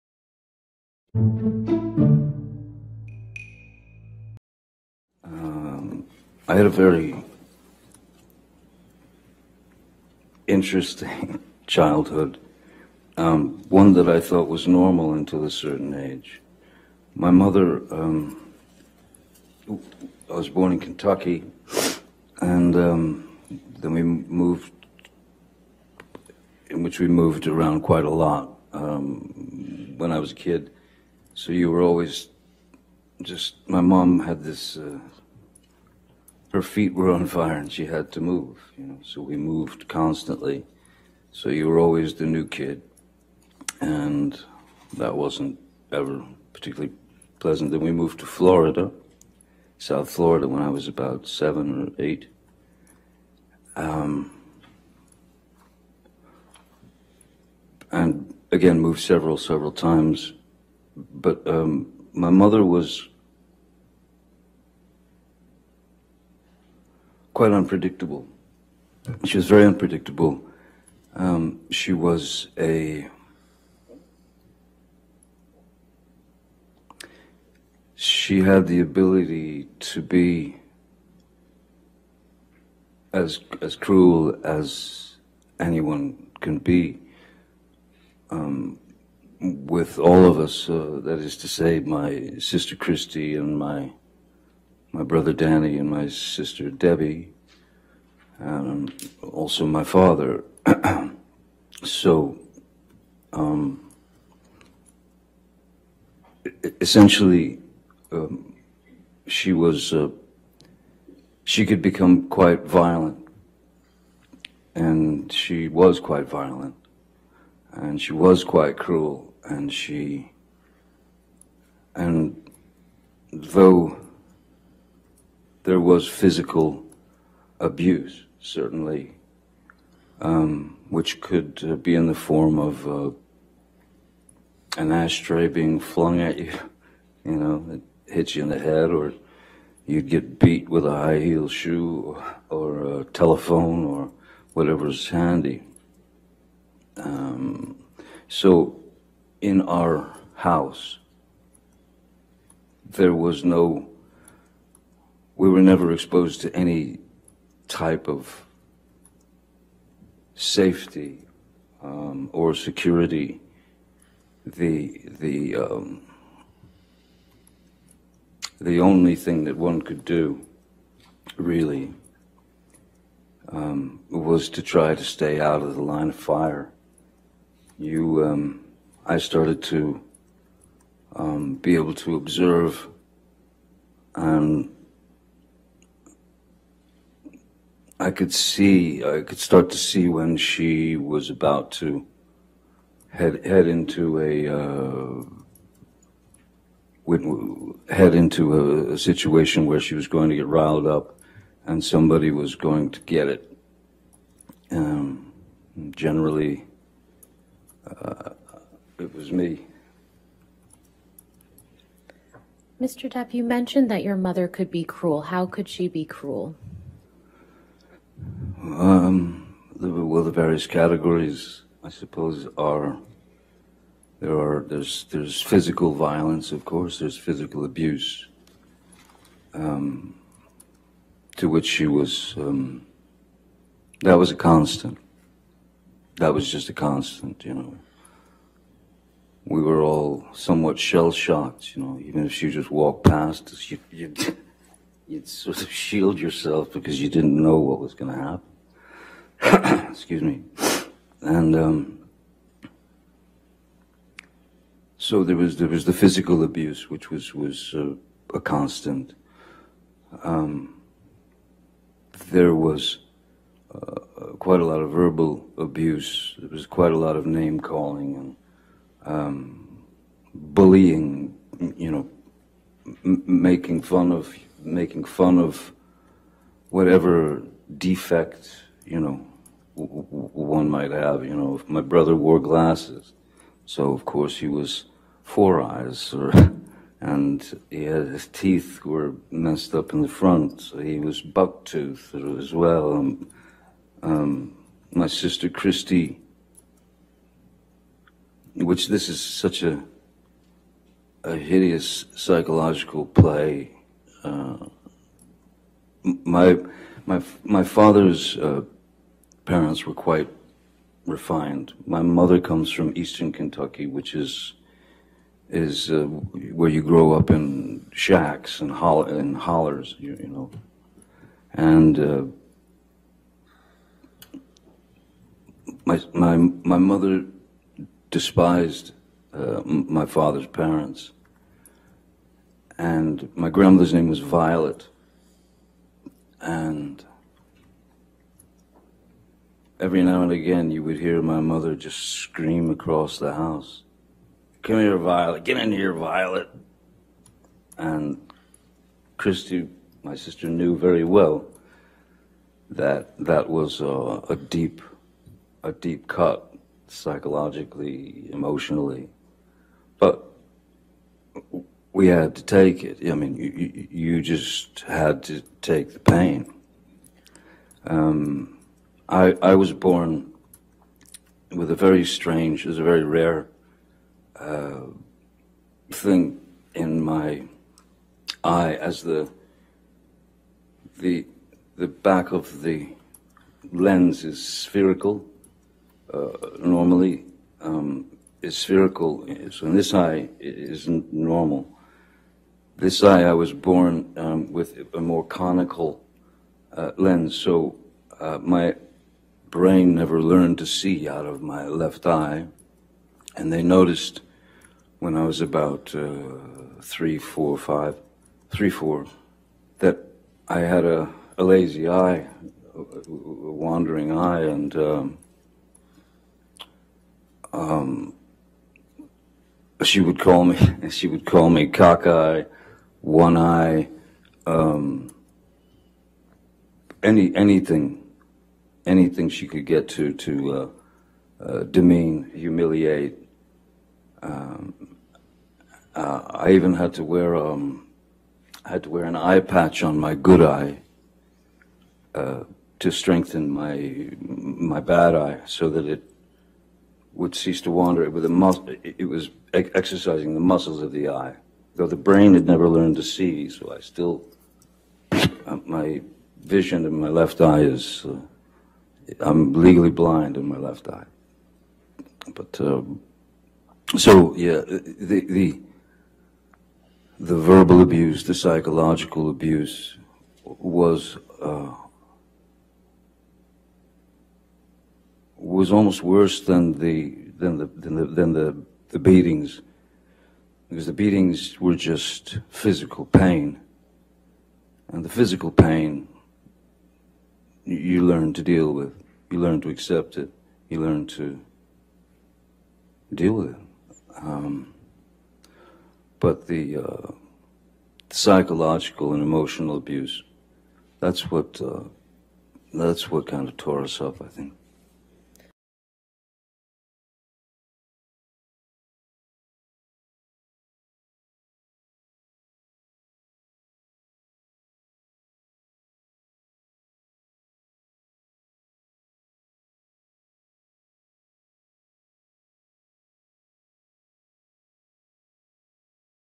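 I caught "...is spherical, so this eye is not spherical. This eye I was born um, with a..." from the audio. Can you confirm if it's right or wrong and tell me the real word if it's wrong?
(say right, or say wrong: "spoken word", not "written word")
wrong: "normal", not "spherical".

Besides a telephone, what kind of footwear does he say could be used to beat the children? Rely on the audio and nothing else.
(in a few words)
high heel shoe.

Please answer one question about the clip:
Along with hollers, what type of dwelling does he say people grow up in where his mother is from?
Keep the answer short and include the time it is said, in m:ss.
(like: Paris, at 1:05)
shacks, at 5:17.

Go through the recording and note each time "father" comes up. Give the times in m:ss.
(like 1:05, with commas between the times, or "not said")
1:39, 5:07, 5:30.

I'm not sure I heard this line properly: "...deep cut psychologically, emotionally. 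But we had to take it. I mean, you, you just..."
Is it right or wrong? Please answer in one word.
right.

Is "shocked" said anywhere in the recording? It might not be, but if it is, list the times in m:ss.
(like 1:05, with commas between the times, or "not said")
4:01.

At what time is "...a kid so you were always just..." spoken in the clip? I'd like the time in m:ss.
0:30.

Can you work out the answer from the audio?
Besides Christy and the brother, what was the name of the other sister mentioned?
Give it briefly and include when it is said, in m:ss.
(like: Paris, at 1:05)
Debbie, at 1:36.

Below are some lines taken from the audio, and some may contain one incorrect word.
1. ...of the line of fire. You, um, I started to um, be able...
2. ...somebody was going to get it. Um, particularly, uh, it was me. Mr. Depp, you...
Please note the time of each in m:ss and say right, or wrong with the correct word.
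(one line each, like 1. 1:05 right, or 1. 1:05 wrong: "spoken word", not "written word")
1. 2:55 right
2. 3:21 wrong: "generally", not "particularly".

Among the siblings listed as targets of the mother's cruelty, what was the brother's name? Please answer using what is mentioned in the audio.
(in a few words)
Danny.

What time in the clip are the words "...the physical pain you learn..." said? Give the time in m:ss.
8:05.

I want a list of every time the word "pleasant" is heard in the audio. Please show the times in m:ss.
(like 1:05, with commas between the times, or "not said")
0:47.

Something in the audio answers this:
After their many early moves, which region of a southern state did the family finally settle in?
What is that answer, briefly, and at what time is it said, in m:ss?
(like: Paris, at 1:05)
South Florida, at 0:49.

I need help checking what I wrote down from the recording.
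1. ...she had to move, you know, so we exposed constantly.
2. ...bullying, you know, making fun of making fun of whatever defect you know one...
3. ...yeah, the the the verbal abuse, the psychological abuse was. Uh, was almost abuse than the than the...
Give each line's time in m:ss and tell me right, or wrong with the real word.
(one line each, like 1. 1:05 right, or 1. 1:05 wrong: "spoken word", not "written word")
1. 0:37 wrong: "moved", not "exposed"
2. 4:30 right
3. 7:44 wrong: "worse", not "abuse".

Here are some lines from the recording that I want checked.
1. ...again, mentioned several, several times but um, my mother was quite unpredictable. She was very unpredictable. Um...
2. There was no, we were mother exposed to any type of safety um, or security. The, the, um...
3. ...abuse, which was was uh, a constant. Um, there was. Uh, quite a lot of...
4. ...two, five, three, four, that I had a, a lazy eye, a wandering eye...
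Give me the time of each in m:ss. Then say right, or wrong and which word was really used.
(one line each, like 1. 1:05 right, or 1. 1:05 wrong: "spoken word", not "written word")
1. 0:58 wrong: "moved", not "mentioned"
2. 2:32 wrong: "never", not "mother"
3. 4:16 right
4. 6:47 wrong: "four", not "two".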